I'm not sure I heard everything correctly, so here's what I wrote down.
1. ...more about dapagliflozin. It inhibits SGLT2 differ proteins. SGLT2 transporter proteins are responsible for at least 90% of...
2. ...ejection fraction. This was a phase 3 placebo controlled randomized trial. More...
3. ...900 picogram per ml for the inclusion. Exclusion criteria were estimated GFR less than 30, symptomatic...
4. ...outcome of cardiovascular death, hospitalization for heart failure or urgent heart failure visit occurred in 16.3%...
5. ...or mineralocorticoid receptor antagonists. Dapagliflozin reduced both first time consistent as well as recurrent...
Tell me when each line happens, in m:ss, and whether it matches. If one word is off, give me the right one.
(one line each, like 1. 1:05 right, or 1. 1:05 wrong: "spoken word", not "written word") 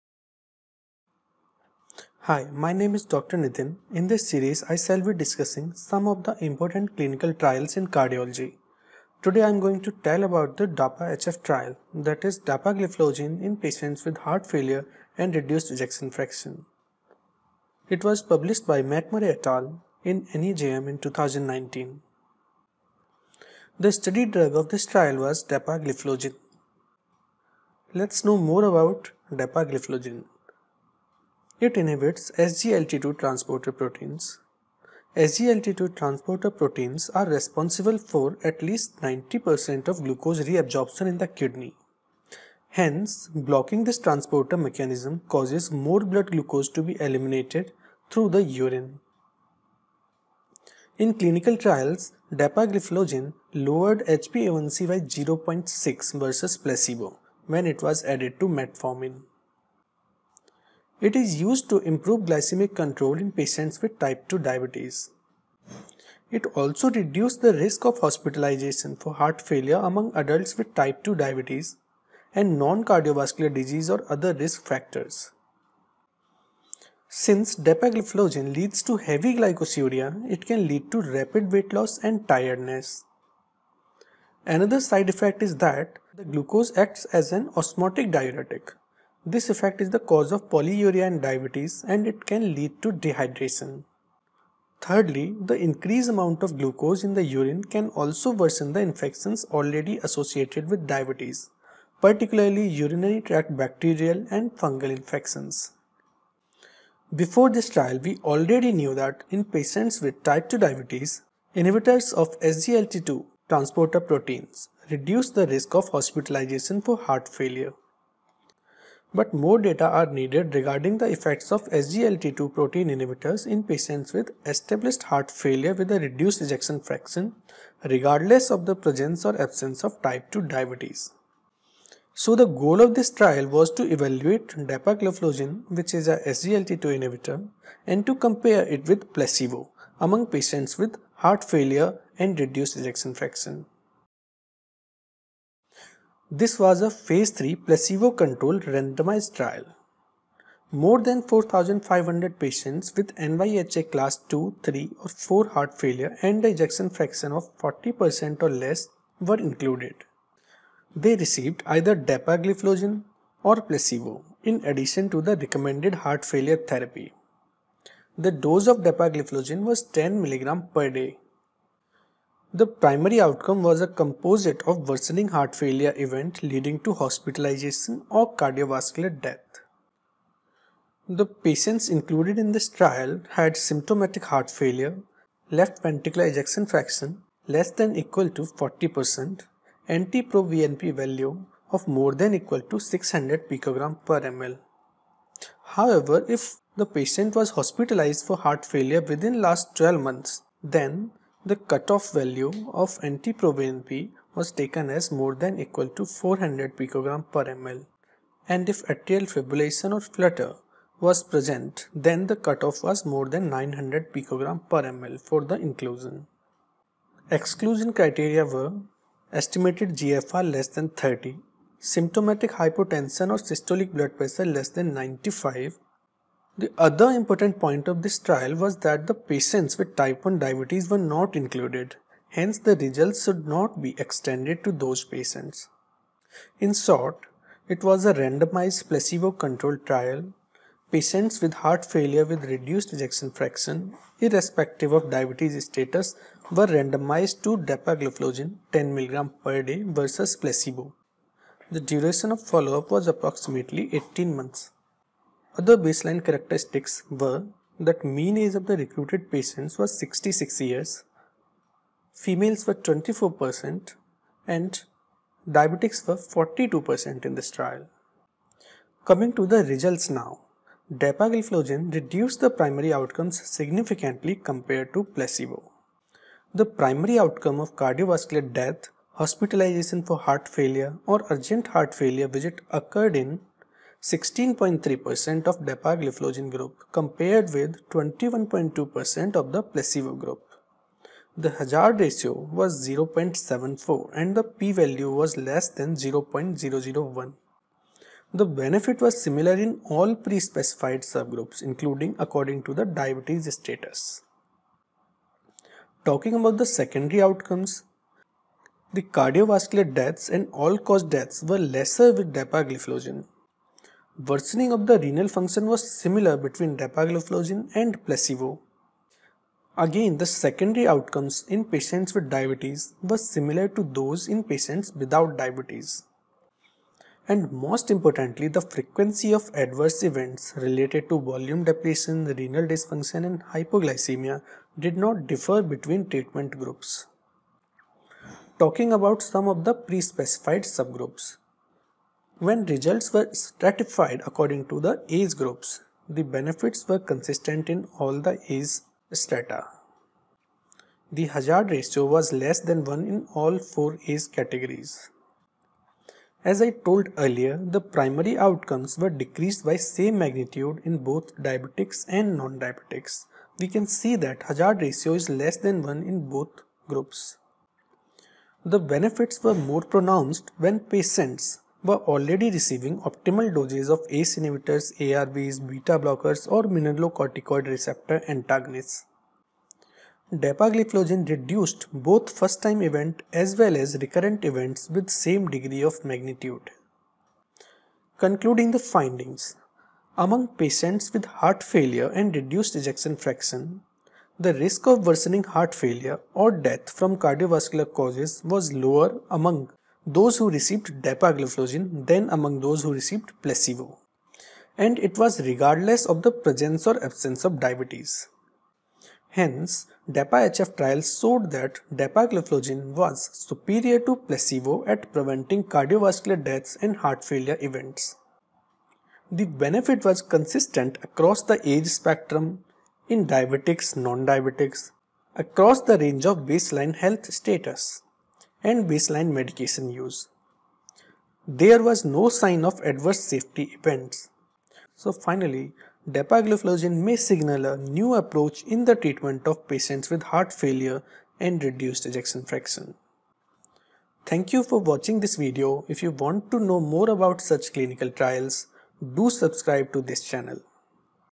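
1. 0:28 wrong: "transporter", not "differ"
2. 2:22 right
3. 3:33 right
4. 4:37 right
5. 6:16 wrong: "event", not "consistent".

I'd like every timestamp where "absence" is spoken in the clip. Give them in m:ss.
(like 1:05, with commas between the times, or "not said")
2:09, 6:47.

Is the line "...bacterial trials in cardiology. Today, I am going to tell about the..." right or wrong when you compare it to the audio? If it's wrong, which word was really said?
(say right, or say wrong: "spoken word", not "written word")
wrong: "clinical", not "bacterial".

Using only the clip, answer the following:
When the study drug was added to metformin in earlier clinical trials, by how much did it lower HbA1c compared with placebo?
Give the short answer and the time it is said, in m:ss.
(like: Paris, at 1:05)
0.6, at 0:55.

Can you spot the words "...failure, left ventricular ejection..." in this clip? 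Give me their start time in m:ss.
3:04.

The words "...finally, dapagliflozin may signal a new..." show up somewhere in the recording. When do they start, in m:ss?
7:15.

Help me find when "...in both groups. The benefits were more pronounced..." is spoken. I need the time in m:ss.
6:06.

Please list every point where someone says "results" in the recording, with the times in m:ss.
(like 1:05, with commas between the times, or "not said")
3:52, 4:29, 5:42.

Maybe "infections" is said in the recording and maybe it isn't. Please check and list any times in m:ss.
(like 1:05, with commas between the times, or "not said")
1:38, 1:44.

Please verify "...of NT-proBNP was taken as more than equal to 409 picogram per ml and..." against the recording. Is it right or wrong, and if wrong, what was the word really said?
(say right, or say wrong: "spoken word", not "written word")
wrong: "400", not "409".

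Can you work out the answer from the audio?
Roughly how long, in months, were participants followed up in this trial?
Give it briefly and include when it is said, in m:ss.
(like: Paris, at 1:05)
18 months, at 4:13.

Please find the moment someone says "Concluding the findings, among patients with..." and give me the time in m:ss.
6:28.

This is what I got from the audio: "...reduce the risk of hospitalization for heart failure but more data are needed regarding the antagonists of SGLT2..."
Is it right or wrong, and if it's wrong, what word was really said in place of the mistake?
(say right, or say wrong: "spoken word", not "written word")
wrong: "effects", not "antagonists".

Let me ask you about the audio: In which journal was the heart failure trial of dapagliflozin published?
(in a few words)
NEJM.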